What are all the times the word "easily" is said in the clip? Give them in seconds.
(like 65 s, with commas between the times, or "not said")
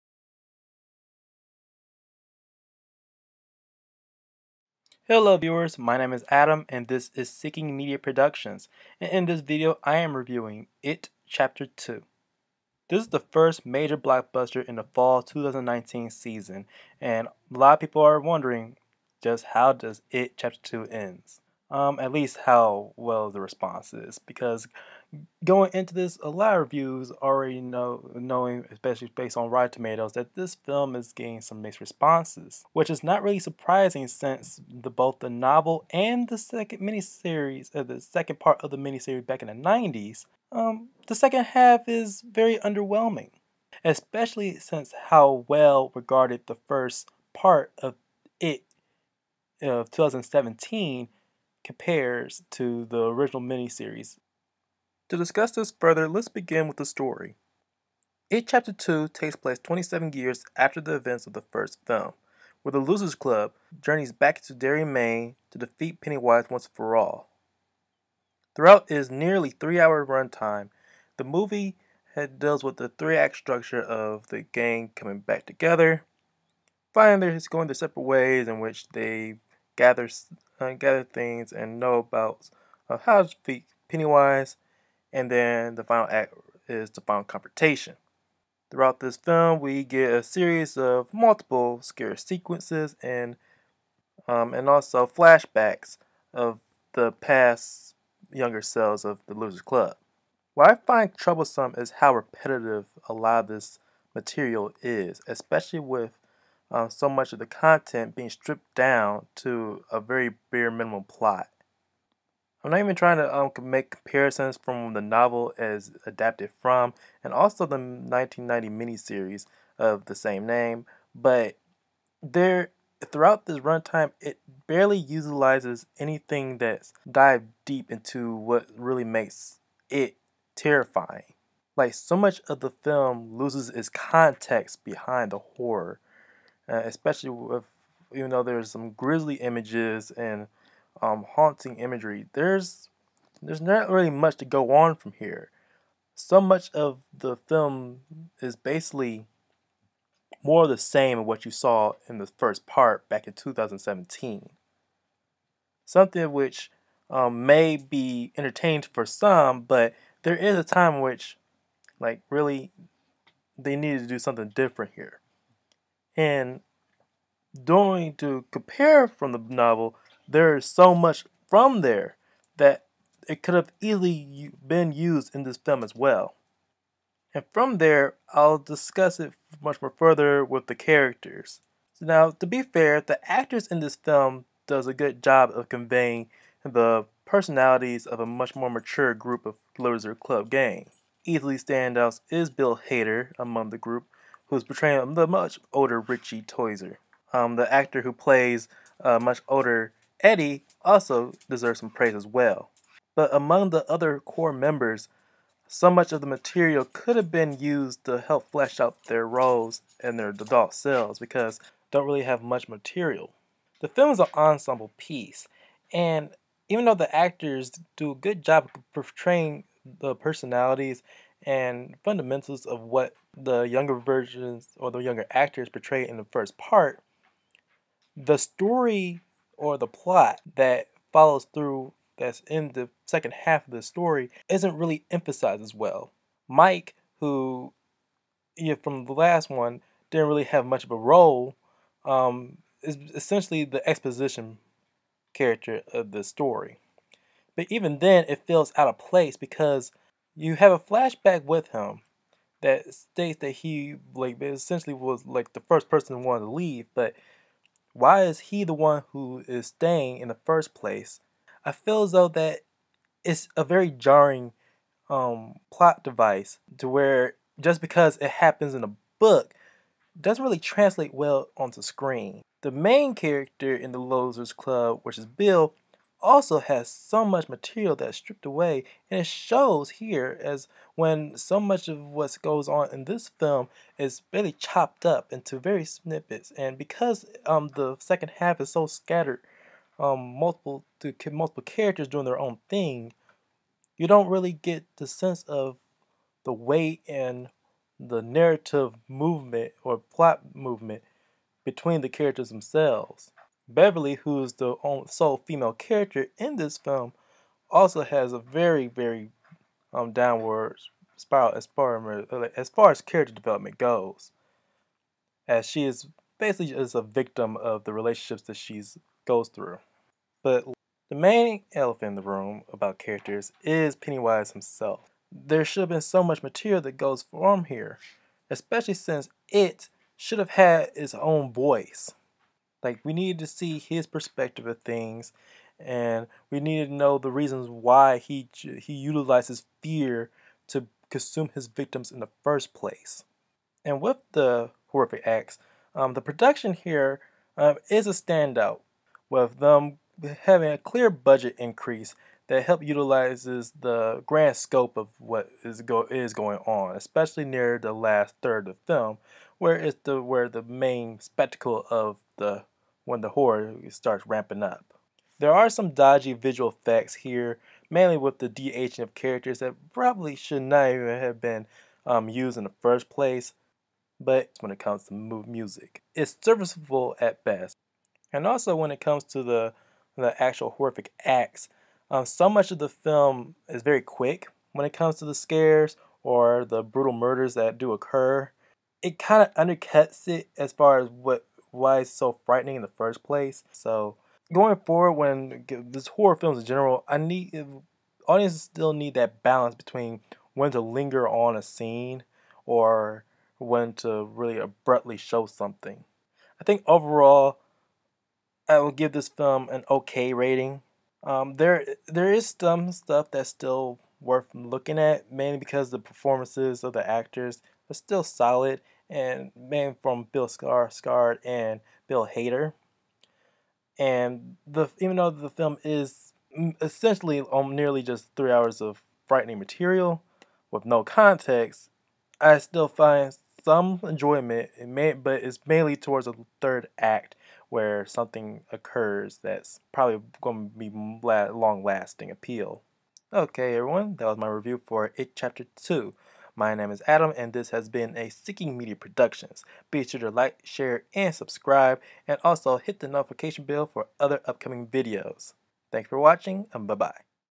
173 s, 191 s.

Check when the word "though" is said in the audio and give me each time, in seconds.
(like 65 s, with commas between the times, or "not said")
138 s, 216 s, 262 s, 425 s.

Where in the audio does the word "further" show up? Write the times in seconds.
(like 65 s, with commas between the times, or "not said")
55 s, 179 s.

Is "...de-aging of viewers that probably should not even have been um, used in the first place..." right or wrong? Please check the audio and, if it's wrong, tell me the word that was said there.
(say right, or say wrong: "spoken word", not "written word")
wrong: "characters", not "viewers".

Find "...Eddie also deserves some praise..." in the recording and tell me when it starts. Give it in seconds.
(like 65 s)
200 s.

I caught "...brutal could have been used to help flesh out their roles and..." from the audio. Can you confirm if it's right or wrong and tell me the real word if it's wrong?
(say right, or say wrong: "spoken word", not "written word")
wrong: "material", not "brutal".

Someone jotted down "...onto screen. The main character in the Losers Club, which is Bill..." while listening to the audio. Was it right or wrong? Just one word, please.
right.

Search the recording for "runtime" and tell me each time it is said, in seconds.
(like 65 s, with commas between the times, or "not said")
70 s, 123 s.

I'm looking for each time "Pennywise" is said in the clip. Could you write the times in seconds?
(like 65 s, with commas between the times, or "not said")
65 s, 83 s, 323 s.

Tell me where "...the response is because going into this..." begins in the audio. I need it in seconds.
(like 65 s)
23 s.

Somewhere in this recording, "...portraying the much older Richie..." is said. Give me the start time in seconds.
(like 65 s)
194 s.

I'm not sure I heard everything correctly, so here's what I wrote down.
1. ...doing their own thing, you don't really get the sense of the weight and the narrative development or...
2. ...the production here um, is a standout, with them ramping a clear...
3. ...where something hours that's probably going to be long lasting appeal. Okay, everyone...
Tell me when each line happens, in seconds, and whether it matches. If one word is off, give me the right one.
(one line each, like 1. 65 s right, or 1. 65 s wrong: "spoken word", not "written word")
1. 292 s wrong: "movement", not "development"
2. 346 s wrong: "having", not "ramping"
3. 437 s wrong: "occurs", not "hours".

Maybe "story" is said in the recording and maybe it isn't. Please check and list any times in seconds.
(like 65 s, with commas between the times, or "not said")
56 s, 228 s, 233 s, 246 s.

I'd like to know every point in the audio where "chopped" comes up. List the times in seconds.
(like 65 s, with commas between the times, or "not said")
284 s.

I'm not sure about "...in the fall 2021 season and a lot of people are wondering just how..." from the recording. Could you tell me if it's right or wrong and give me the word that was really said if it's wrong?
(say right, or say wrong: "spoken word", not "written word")
wrong: "2019", not "2021".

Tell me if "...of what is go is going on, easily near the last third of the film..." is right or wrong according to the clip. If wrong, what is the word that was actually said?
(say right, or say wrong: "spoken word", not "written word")
wrong: "especially", not "easily".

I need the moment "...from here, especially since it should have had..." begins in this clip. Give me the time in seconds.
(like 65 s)
327 s.